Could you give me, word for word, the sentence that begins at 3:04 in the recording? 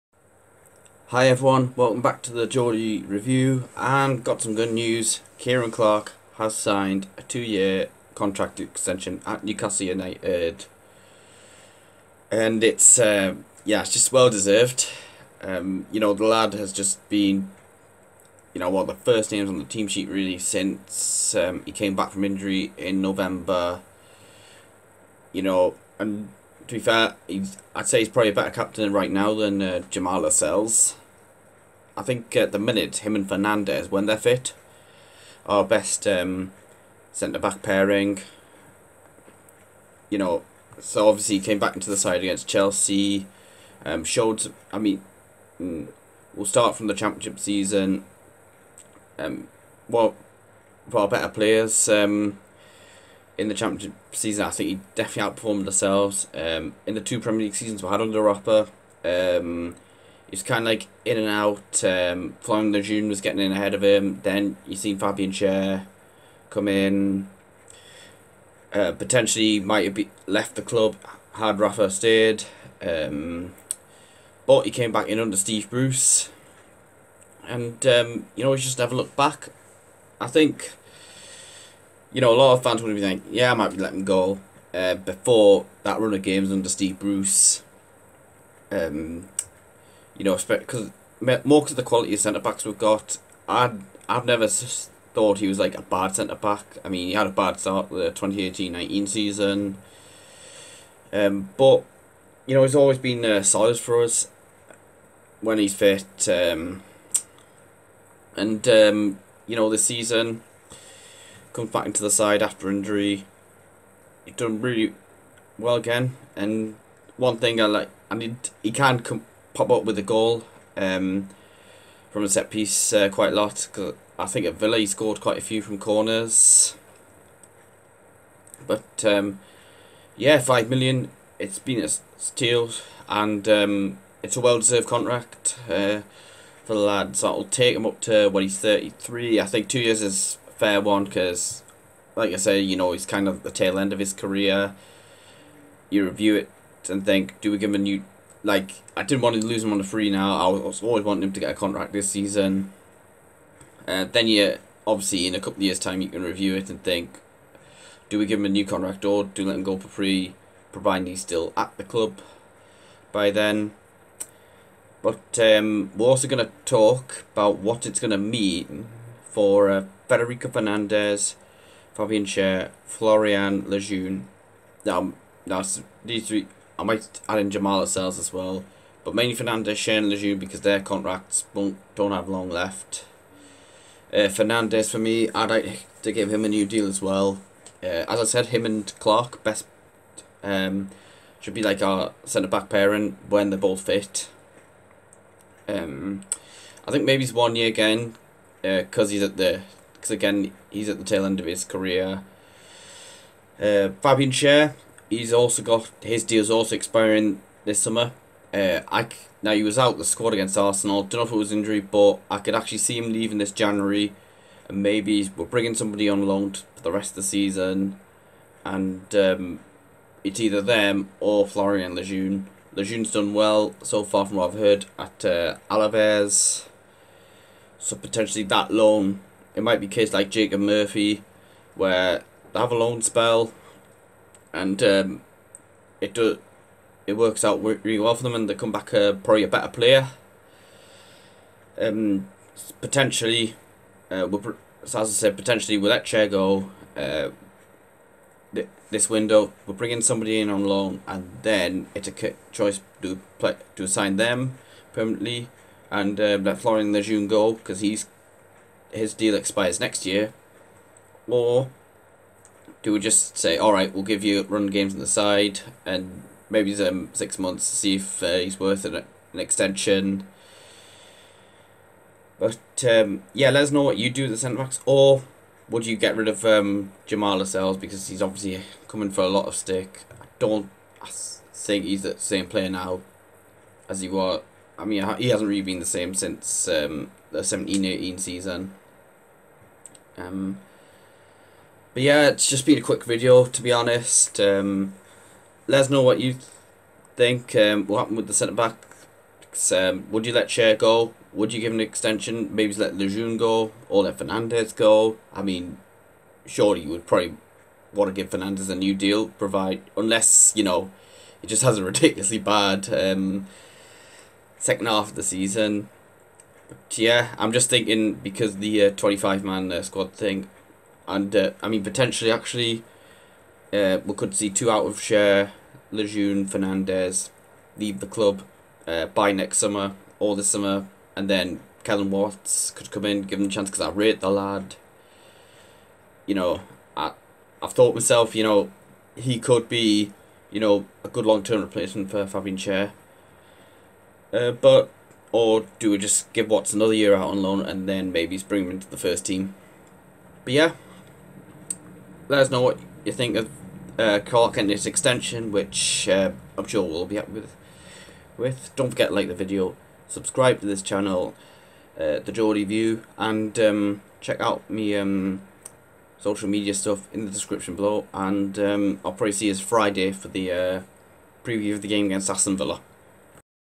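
Uh, Fernandez for me, I'd like to give him a new deal as well.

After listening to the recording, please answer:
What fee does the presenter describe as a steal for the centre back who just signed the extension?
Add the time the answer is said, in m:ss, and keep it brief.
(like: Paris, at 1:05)
5 million, at 2:10.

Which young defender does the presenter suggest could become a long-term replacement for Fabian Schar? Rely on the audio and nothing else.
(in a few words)
Kelland Watts.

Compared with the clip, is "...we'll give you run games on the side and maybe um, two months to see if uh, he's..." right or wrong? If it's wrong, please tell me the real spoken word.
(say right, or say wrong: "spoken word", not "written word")
wrong: "six", not "two".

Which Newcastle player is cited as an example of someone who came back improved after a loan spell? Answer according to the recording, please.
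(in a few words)
Jacob Murphy.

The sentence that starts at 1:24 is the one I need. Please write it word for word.
Uh, before that run of games under Steve Bruce, um, you know, because more because the quality of centre backs we've got.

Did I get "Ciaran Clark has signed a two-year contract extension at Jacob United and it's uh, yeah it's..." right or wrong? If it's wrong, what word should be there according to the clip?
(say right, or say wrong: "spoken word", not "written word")
wrong: "Newcastle", not "Jacob".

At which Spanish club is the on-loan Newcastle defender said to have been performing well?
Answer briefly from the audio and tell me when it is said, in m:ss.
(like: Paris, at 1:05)
Alaves, at 3:45.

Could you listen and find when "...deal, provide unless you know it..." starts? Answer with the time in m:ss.
5:08.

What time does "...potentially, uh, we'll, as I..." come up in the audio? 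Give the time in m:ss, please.
4:02.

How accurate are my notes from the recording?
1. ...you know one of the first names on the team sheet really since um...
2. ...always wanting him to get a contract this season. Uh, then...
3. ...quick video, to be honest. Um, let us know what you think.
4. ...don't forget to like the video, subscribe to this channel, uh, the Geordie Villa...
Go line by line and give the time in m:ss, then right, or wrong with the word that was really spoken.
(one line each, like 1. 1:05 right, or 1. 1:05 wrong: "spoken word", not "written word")
1. 0:18 right
2. 2:30 right
3. 4:52 right
4. 5:58 wrong: "View", not "Villa".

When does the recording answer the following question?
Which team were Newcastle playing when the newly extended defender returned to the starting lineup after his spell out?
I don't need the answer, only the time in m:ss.
0:42.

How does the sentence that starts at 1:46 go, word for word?
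Um, and um, you know, this season comes back into the side after injury.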